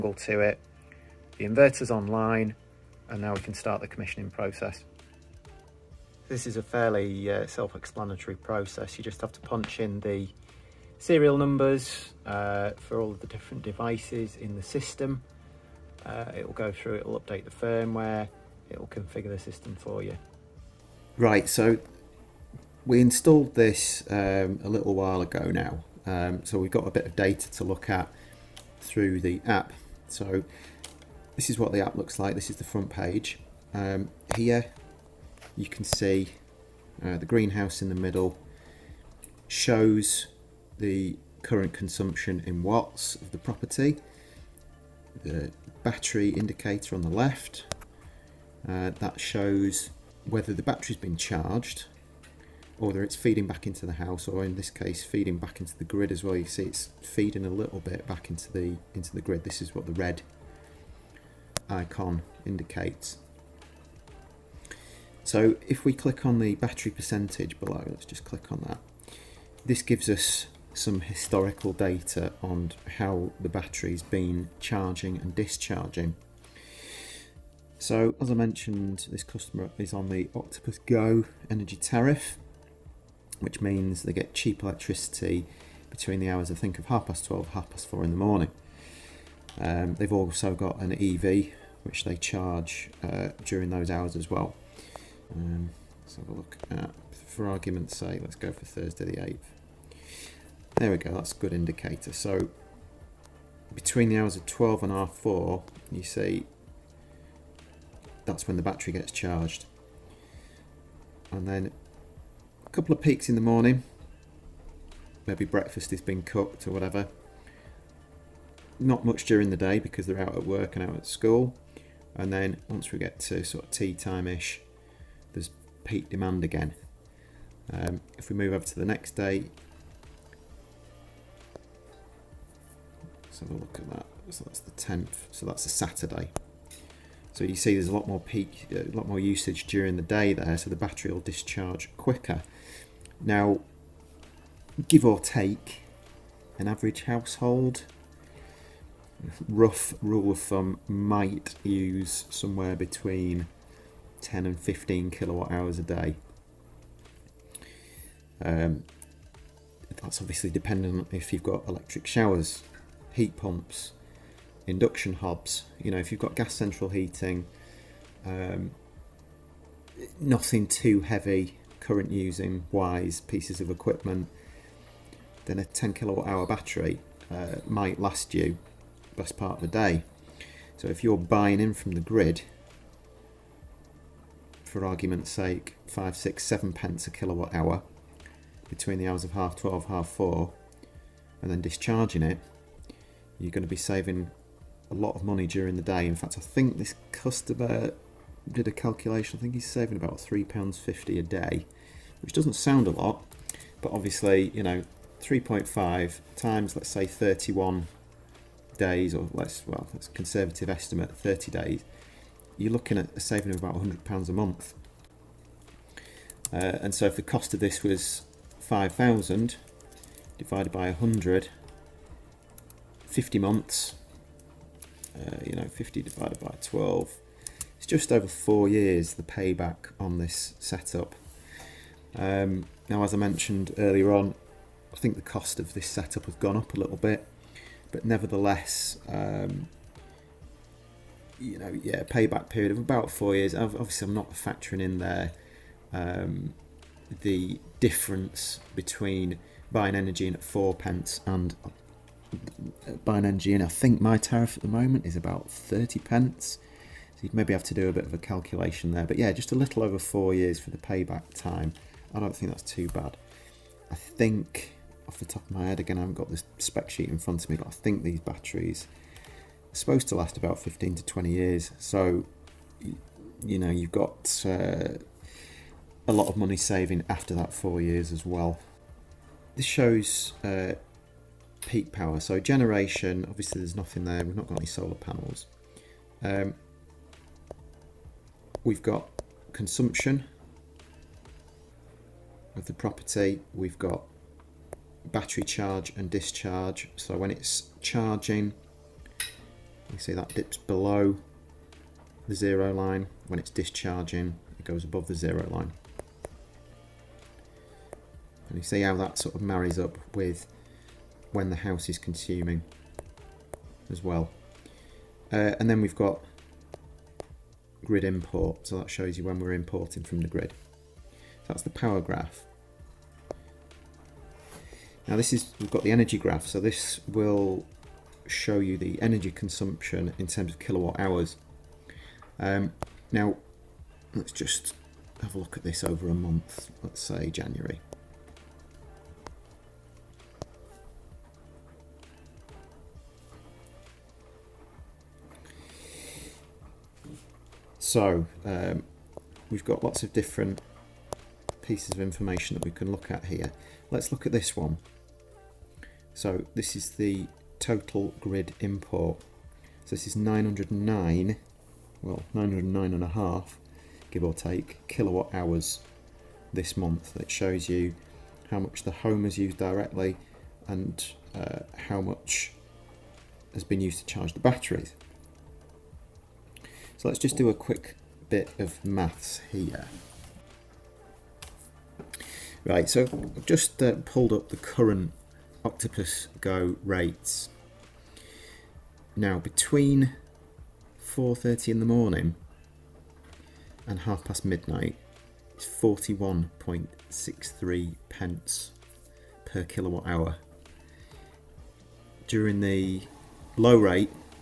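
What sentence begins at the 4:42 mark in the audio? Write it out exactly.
So generation, obviously there's nothing there.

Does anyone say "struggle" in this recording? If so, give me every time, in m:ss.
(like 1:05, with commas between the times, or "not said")
not said.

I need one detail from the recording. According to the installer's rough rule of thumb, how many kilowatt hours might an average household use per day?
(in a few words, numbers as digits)
10 to 15.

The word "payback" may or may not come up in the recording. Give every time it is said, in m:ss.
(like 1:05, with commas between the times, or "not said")
3:49, 4:02, 4:20.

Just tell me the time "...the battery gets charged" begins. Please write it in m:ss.
1:48.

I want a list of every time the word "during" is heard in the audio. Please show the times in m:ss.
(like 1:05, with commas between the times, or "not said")
1:33, 1:59, 2:19, 3:15, 6:42.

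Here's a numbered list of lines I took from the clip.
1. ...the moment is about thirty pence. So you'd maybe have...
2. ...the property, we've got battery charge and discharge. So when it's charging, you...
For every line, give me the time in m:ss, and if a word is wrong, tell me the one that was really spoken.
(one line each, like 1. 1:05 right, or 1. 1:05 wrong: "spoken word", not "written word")
1. 4:14 right
2. 4:52 right.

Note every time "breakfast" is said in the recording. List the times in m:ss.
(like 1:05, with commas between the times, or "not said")
1:55.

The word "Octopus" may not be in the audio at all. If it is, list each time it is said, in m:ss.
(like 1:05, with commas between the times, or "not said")
1:20, 6:25.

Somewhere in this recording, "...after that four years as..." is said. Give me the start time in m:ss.
4:37.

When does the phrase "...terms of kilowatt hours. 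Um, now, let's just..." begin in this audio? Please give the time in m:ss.
5:30.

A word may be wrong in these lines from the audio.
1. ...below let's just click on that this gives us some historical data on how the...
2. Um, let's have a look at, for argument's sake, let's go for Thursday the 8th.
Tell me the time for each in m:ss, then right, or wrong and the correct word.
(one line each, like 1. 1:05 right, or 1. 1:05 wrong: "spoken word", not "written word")
1. 1:07 right
2. 1:35 right.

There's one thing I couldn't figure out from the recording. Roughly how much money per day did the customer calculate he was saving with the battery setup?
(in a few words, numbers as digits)
£3.50.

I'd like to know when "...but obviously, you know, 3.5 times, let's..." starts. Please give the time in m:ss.
3:23.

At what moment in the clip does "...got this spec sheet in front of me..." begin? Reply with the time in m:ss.
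4:26.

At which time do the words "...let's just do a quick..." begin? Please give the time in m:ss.
6:17.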